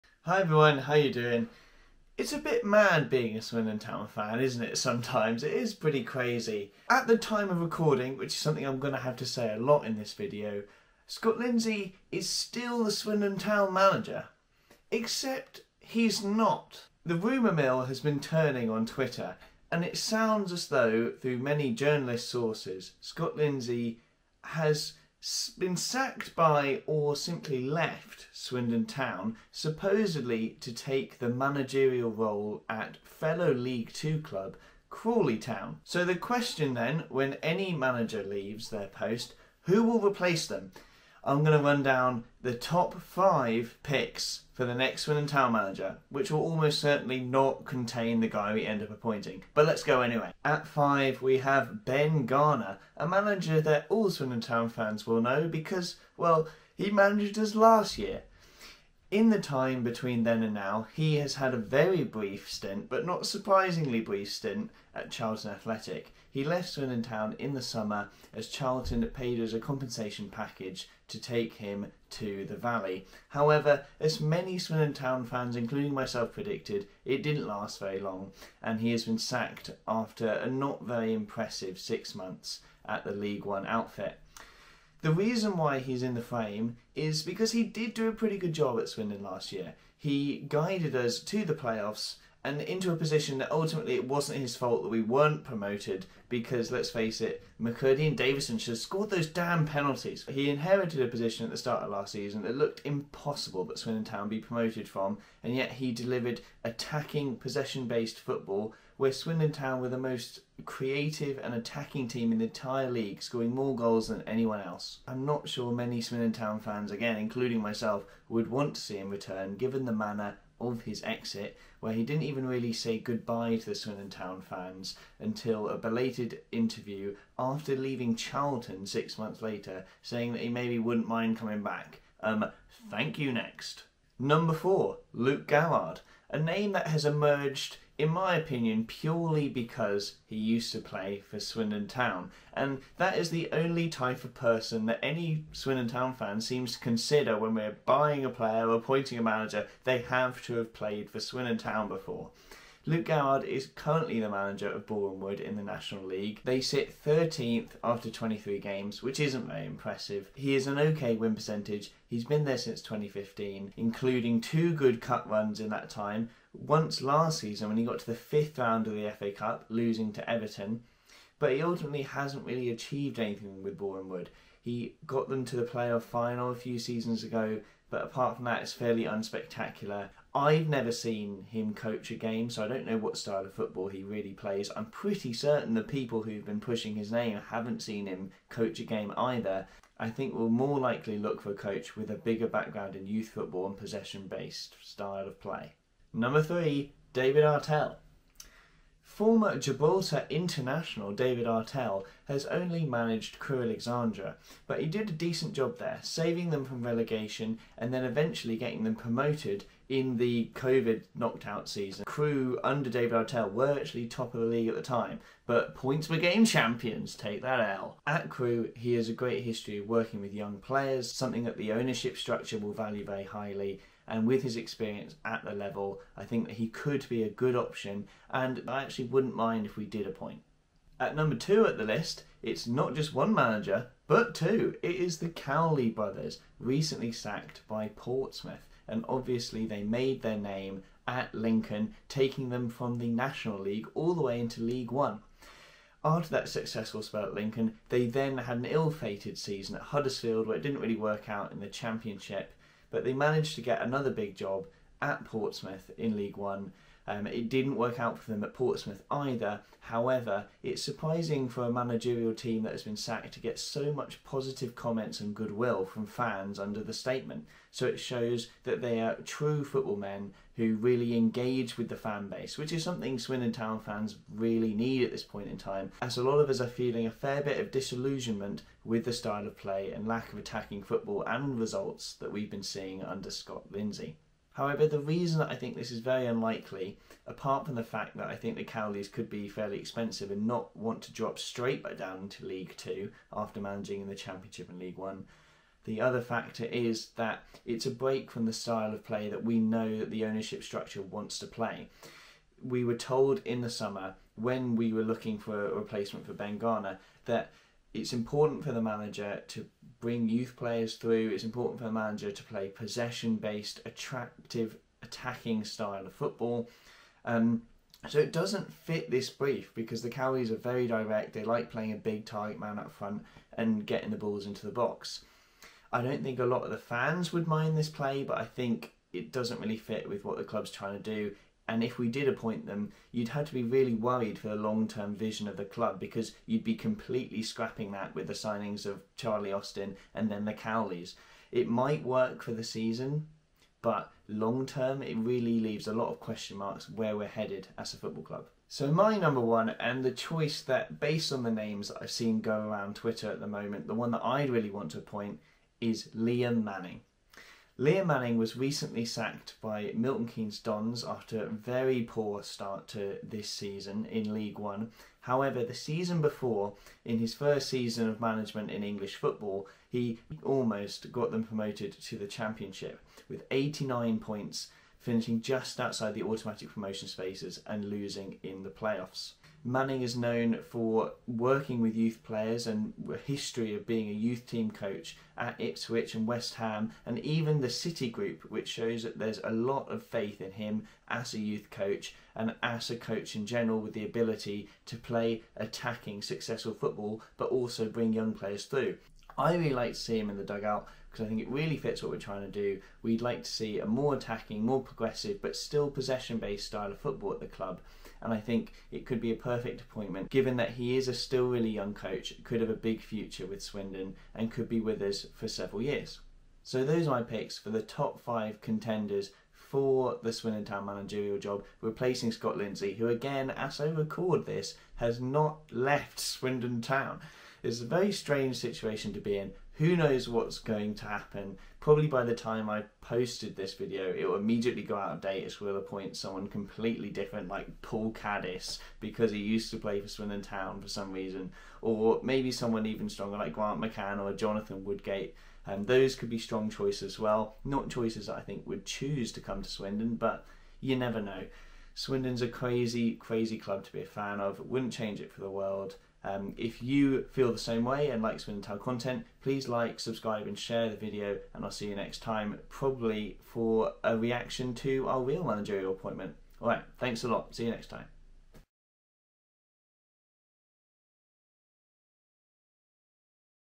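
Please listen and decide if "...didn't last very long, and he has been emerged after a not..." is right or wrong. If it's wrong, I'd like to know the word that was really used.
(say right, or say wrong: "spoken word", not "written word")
wrong: "sacked", not "emerged".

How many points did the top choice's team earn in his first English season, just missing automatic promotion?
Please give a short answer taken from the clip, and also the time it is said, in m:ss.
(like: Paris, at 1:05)
89, at 6:13.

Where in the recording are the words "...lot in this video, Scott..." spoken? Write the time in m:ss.
0:09.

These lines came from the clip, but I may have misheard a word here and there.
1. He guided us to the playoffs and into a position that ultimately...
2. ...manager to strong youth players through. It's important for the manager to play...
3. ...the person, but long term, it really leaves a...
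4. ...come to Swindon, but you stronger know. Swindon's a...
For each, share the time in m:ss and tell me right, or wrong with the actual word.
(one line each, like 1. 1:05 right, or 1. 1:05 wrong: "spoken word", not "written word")
1. 1:29 right
2. 5:08 wrong: "bring", not "strong"
3. 5:42 wrong: "season", not "person"
4. 7:29 wrong: "never", not "stronger".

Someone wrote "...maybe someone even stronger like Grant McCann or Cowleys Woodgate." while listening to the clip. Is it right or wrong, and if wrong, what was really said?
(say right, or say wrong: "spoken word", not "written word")
wrong: "Jonathan", not "Cowleys".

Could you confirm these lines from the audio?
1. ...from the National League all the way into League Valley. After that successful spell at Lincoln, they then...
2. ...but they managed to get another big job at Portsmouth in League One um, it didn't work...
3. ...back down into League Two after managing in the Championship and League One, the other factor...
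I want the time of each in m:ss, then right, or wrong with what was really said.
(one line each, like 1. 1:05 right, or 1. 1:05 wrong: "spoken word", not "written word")
1. 4:02 wrong: "One", not "Valley"
2. 4:12 right
3. 4:51 right.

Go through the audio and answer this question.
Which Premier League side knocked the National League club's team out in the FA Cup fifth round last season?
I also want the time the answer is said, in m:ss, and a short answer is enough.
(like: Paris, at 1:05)
Everton, at 2:50.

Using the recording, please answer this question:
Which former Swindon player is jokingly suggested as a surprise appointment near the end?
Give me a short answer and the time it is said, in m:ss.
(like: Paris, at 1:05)
Paul Caddis, at 7:17.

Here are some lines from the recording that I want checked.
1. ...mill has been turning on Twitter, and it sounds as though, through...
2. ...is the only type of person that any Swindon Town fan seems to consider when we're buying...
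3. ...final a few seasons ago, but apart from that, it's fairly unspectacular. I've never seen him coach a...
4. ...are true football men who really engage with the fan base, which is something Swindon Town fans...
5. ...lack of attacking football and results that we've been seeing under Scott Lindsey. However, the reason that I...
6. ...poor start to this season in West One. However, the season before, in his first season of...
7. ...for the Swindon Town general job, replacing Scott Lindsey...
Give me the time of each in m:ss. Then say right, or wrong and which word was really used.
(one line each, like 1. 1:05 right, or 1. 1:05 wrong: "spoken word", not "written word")
1. 0:17 right
2. 2:23 right
3. 2:56 right
4. 4:29 right
5. 4:40 right
6. 6:02 wrong: "League", not "West"
7. 6:59 wrong: "managerial", not "general".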